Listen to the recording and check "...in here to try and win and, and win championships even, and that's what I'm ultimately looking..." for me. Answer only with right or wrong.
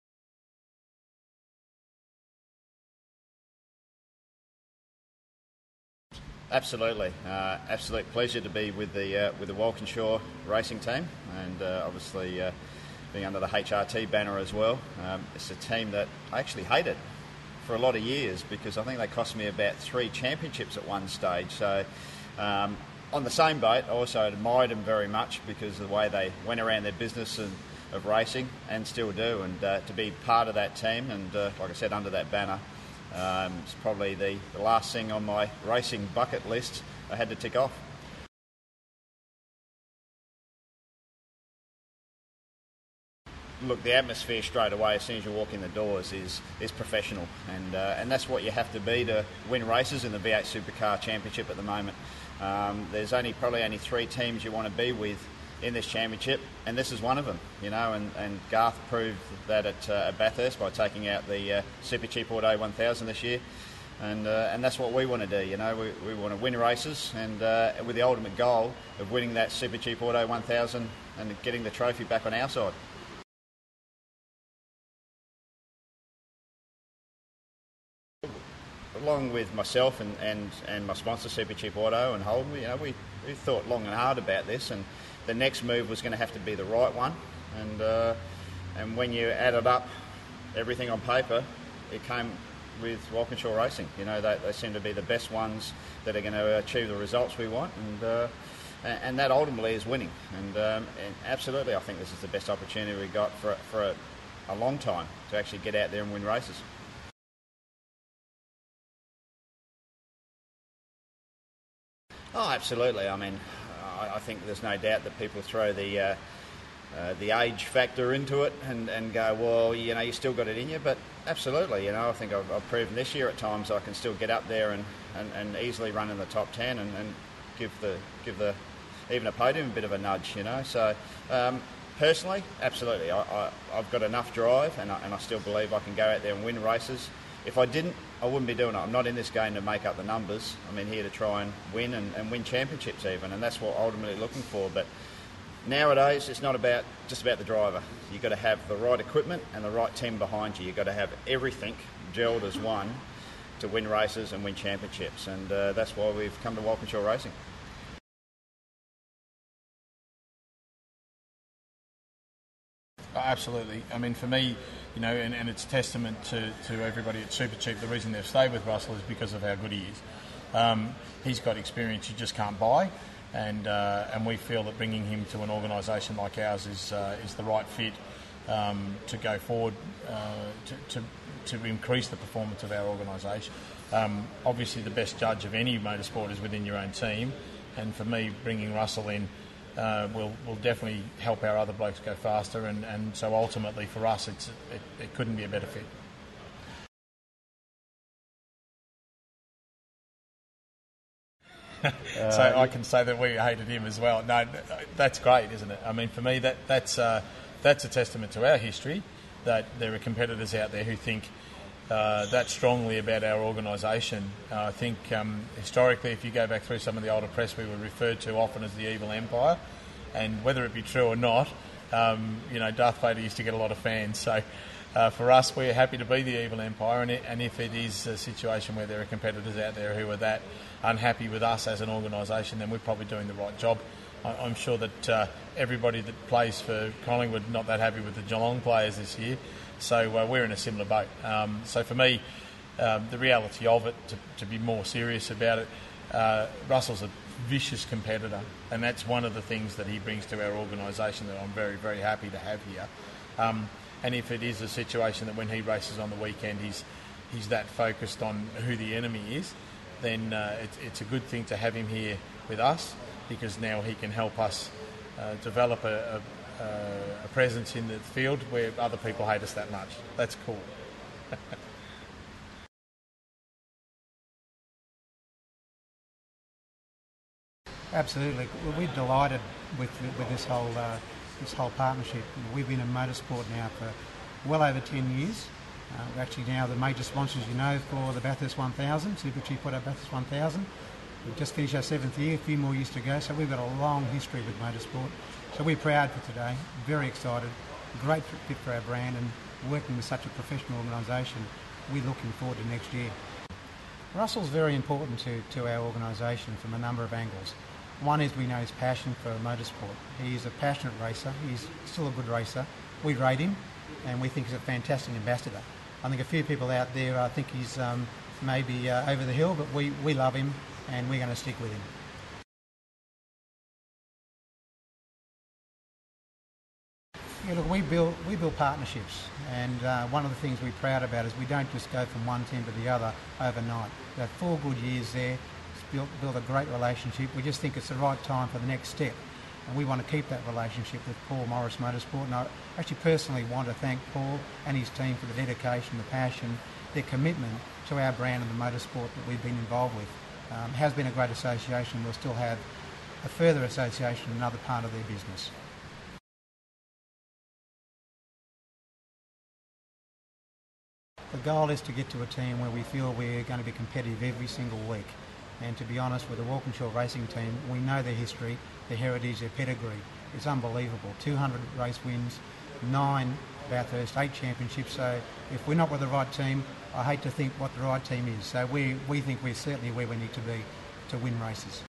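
right.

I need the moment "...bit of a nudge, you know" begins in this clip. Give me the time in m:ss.
2:09.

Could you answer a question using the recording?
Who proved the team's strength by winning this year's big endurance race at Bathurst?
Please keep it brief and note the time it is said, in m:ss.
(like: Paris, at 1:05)
Garth, at 0:58.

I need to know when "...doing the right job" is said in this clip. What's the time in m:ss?
3:53.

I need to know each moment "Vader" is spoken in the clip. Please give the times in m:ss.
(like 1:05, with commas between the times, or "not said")
3:43.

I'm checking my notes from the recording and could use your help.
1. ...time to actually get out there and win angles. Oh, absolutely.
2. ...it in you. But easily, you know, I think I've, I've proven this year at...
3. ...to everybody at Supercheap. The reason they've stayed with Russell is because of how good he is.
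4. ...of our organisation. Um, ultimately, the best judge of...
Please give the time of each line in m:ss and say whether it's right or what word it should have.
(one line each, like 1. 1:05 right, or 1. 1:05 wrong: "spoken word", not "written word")
1. 1:44 wrong: "races", not "angles"
2. 2:00 wrong: "absolutely", not "easily"
3. 2:46 right
4. 3:02 wrong: "obviously", not "ultimately".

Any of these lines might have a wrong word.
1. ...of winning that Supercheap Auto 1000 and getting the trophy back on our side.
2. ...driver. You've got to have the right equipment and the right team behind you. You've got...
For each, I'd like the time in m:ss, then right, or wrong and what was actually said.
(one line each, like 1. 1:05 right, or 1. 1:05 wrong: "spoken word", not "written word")
1. 1:08 right
2. 2:27 right.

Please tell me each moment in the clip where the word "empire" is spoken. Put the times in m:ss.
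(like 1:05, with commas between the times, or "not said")
3:39, 3:46.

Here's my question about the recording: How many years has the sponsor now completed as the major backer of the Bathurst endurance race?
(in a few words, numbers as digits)
7.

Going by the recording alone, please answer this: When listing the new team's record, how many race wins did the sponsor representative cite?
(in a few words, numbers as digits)
200.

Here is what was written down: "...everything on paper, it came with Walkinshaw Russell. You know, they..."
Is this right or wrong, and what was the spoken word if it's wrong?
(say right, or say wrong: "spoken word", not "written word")
wrong: "Racing", not "Russell".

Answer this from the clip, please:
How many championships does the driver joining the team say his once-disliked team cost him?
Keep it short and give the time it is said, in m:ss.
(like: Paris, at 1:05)
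3, at 0:19.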